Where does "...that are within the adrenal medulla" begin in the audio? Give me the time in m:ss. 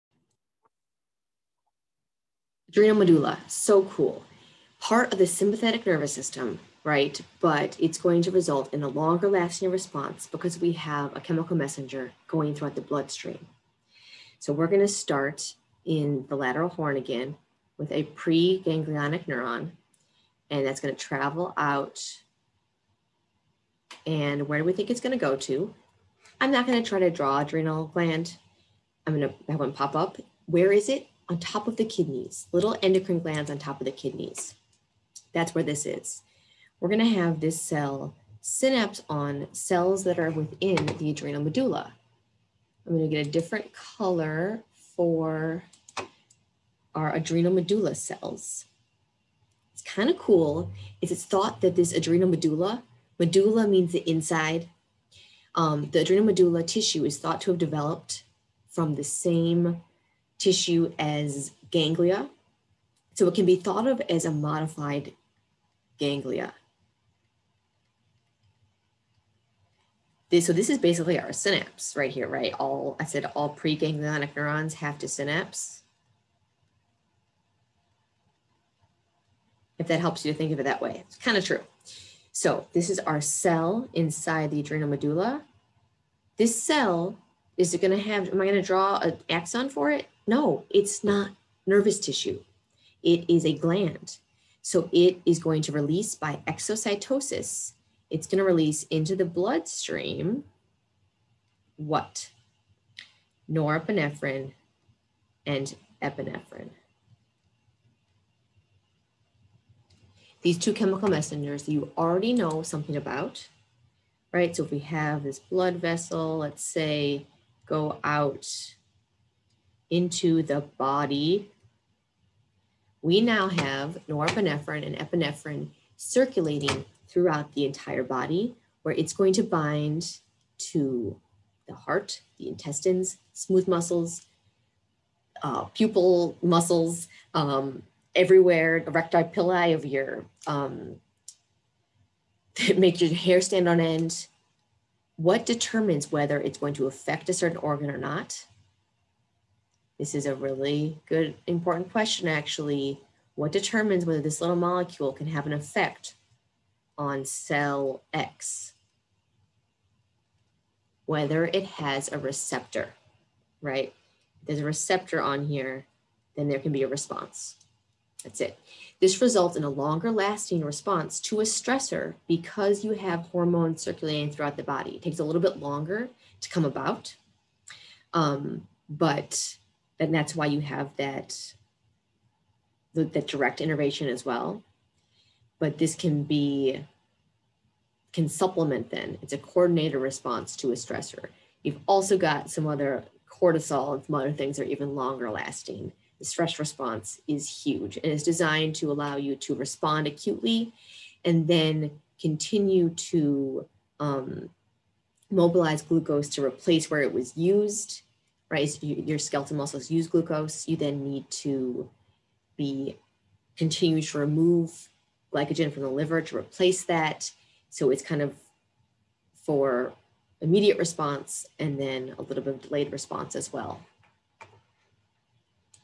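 0:40.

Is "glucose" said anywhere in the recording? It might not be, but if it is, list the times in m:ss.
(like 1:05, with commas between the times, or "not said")
3:25, 3:30.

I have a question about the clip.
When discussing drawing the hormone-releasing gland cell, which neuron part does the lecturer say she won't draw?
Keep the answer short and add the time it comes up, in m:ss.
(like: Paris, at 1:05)
An axon, at 1:29.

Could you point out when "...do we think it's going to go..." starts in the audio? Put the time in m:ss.
0:24.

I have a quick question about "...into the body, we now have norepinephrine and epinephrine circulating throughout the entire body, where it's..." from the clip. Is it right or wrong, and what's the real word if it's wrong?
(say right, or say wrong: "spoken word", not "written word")
right.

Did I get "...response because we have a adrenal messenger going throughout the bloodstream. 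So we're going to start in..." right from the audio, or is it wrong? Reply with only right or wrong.
wrong.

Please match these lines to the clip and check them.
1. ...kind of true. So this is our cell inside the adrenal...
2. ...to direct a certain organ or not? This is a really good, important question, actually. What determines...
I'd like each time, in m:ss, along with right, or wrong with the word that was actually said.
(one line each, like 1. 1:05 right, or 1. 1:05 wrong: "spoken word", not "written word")
1. 1:21 right
2. 2:26 wrong: "affect", not "direct".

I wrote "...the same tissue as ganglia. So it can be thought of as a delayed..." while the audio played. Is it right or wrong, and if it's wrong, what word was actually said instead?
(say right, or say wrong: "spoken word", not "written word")
wrong: "modified", not "delayed".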